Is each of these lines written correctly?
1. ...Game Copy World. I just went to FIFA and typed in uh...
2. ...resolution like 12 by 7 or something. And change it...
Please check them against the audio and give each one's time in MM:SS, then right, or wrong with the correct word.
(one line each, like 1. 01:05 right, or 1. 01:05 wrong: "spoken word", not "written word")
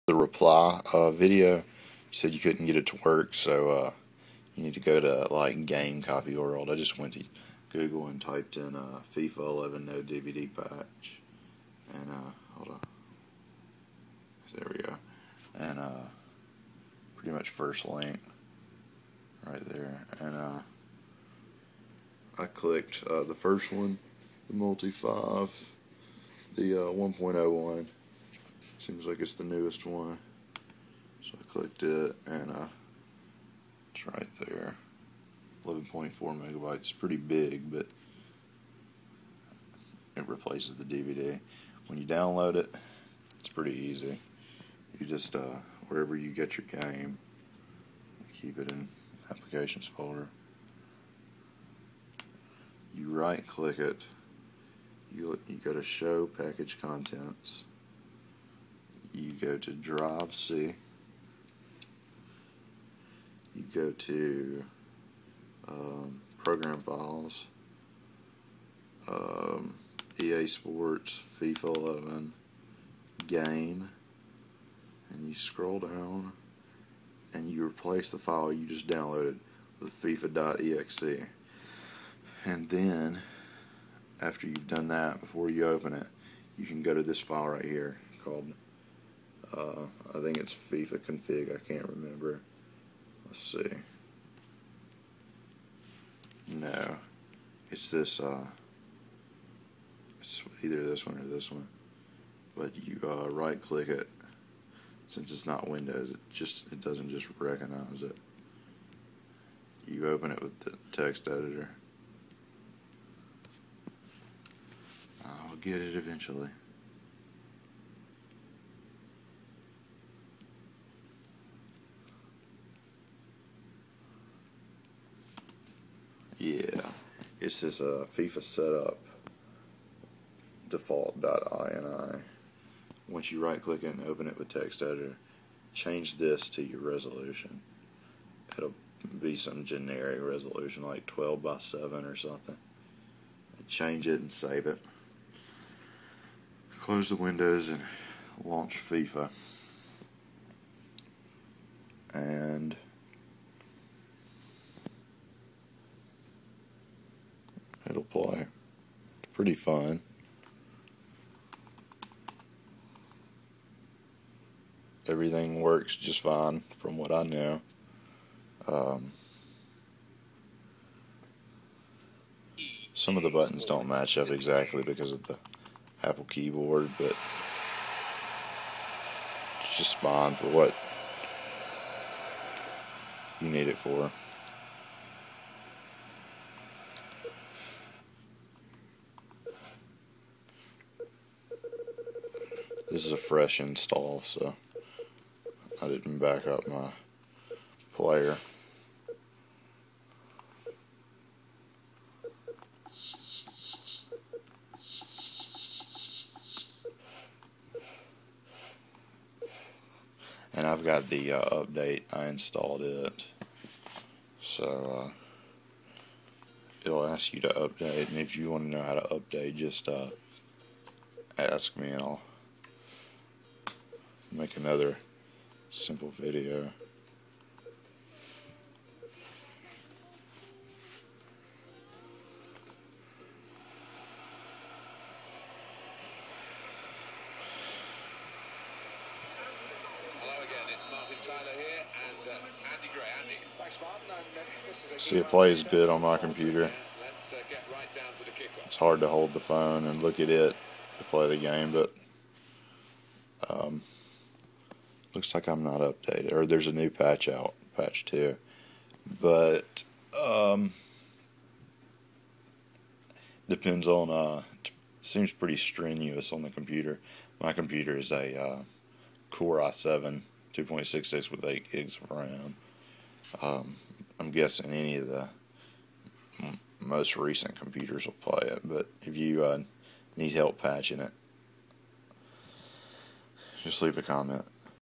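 1. 00:05 wrong: "Google", not "FIFA"
2. 02:20 right.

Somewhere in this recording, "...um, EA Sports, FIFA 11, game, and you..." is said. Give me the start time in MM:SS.
01:09.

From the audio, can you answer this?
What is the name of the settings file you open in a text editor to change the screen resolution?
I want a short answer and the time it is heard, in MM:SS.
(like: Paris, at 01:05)
FIFA setup default.ini, at 02:08.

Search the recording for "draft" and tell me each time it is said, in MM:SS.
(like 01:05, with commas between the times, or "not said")
not said.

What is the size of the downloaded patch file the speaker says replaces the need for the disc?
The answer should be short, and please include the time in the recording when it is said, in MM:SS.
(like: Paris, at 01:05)
11.4 megabytes, at 00:35.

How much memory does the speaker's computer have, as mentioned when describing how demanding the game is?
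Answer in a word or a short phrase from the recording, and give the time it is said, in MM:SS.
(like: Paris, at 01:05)
8 gigs, at 04:31.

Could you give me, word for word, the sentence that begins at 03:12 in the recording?
This is a fresh install, so I didn't back up my player.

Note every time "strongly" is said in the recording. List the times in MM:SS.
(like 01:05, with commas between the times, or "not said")
not said.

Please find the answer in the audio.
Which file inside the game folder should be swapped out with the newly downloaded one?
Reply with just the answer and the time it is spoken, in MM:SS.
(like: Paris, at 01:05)
FIFA.exe, at 01:20.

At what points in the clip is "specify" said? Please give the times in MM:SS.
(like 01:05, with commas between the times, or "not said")
not said.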